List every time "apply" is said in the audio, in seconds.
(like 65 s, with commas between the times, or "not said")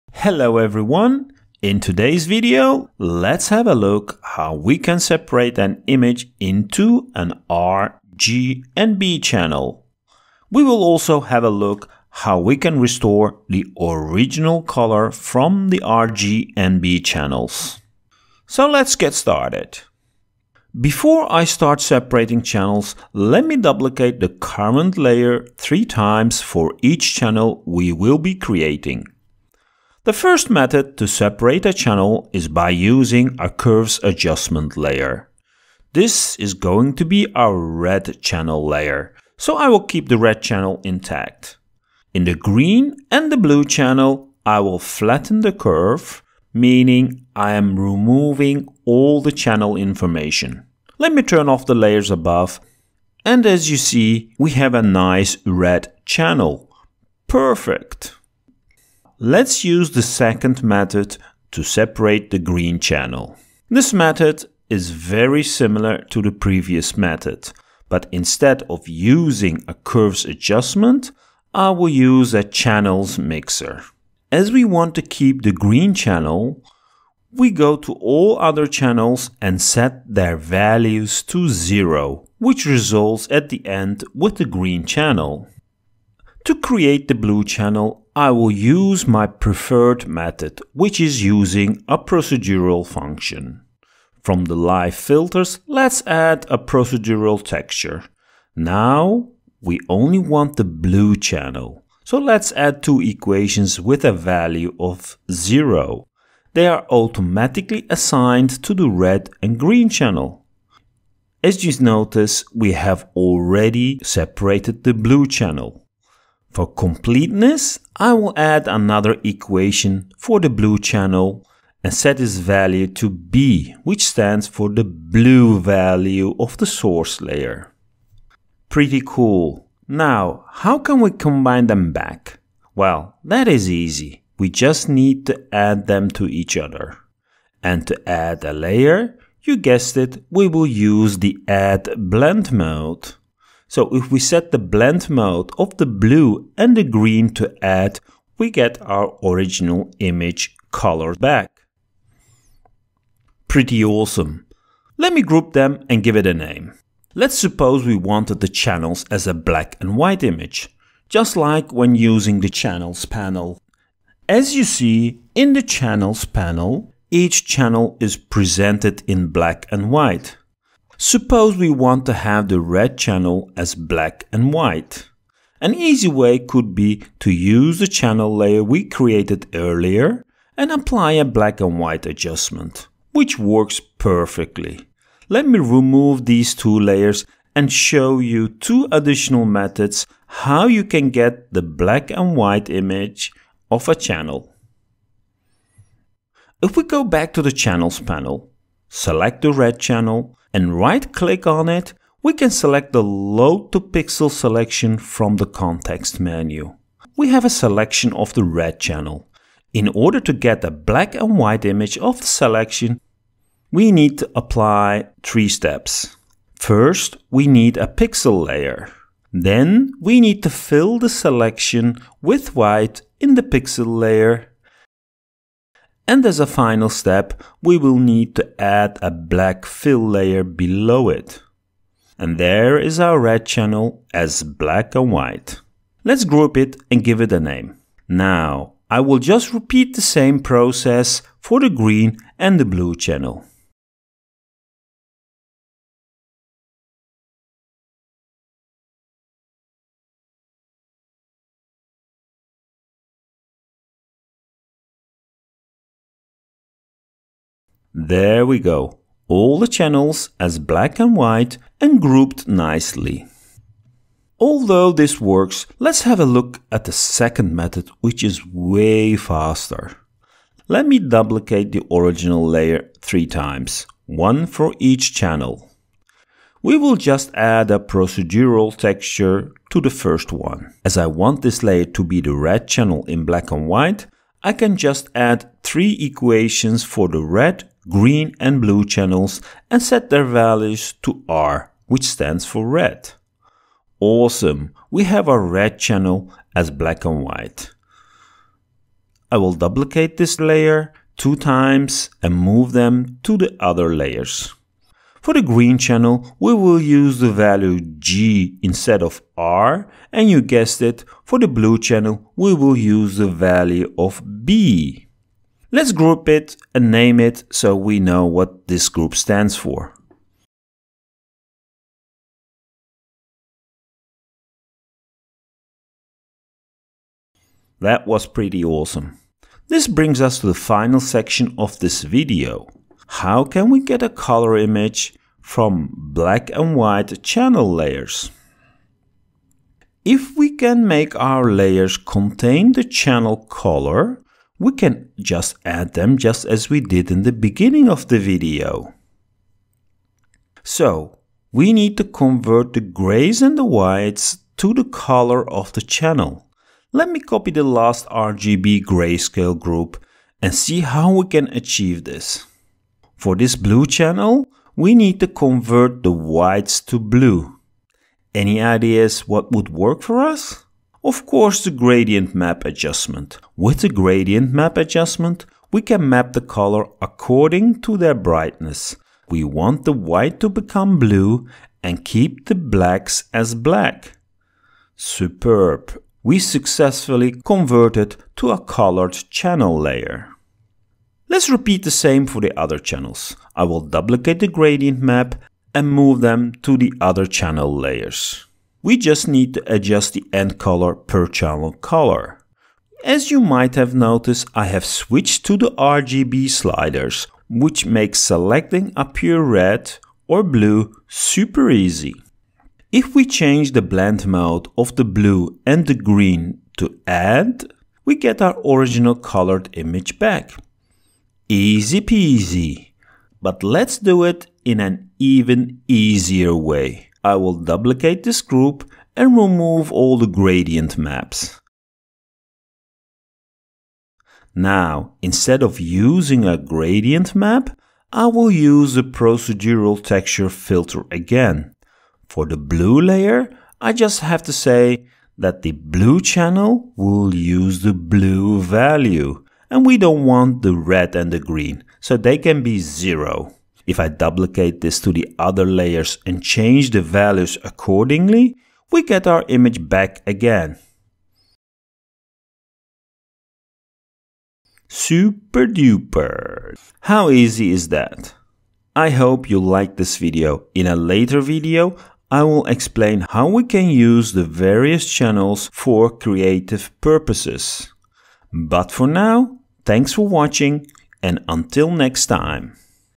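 180 s, 214 s.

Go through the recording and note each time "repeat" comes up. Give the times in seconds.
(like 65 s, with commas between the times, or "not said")
239 s, 391 s.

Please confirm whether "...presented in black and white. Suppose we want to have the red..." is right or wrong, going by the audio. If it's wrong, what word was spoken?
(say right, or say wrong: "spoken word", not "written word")
right.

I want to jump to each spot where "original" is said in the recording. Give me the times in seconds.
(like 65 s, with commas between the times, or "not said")
13 s, 149 s, 271 s, 418 s.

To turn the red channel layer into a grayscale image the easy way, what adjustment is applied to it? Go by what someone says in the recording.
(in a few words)
Black and white adjustment.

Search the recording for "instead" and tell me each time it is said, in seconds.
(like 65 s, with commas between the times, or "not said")
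68 s, 308 s, 435 s.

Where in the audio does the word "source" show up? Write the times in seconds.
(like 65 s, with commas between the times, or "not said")
126 s.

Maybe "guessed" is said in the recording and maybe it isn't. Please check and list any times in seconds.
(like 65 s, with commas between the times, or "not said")
139 s, 310 s.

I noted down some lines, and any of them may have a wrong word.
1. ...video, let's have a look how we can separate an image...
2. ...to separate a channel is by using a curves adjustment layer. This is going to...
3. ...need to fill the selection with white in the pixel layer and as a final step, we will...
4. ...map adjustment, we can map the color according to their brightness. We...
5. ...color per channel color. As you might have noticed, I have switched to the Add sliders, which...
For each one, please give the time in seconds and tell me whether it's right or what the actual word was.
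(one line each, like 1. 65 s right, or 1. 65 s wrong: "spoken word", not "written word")
1. 2 s right
2. 30 s right
3. 220 s right
4. 374 s right
5. 400 s wrong: "RGB", not "Add".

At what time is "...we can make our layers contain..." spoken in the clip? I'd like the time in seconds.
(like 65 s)
340 s.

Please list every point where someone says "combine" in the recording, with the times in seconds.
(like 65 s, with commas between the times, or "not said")
131 s.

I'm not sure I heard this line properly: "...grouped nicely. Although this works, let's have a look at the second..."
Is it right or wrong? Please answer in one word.
right.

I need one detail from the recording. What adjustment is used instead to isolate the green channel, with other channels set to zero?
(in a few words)
Channels mixer.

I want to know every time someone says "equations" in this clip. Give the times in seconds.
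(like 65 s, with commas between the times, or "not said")
102 s, 119 s, 285 s.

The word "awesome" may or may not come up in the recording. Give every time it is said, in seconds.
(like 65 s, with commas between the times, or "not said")
153 s, 293 s, 328 s.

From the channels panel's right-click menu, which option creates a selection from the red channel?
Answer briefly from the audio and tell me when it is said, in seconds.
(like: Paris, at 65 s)
Load to pixel selection, at 203 s.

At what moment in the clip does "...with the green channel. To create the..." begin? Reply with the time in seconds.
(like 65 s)
84 s.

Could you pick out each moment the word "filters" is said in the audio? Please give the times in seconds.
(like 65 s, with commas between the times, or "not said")
94 s, 440 s.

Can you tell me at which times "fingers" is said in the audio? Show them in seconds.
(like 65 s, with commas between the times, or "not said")
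not said.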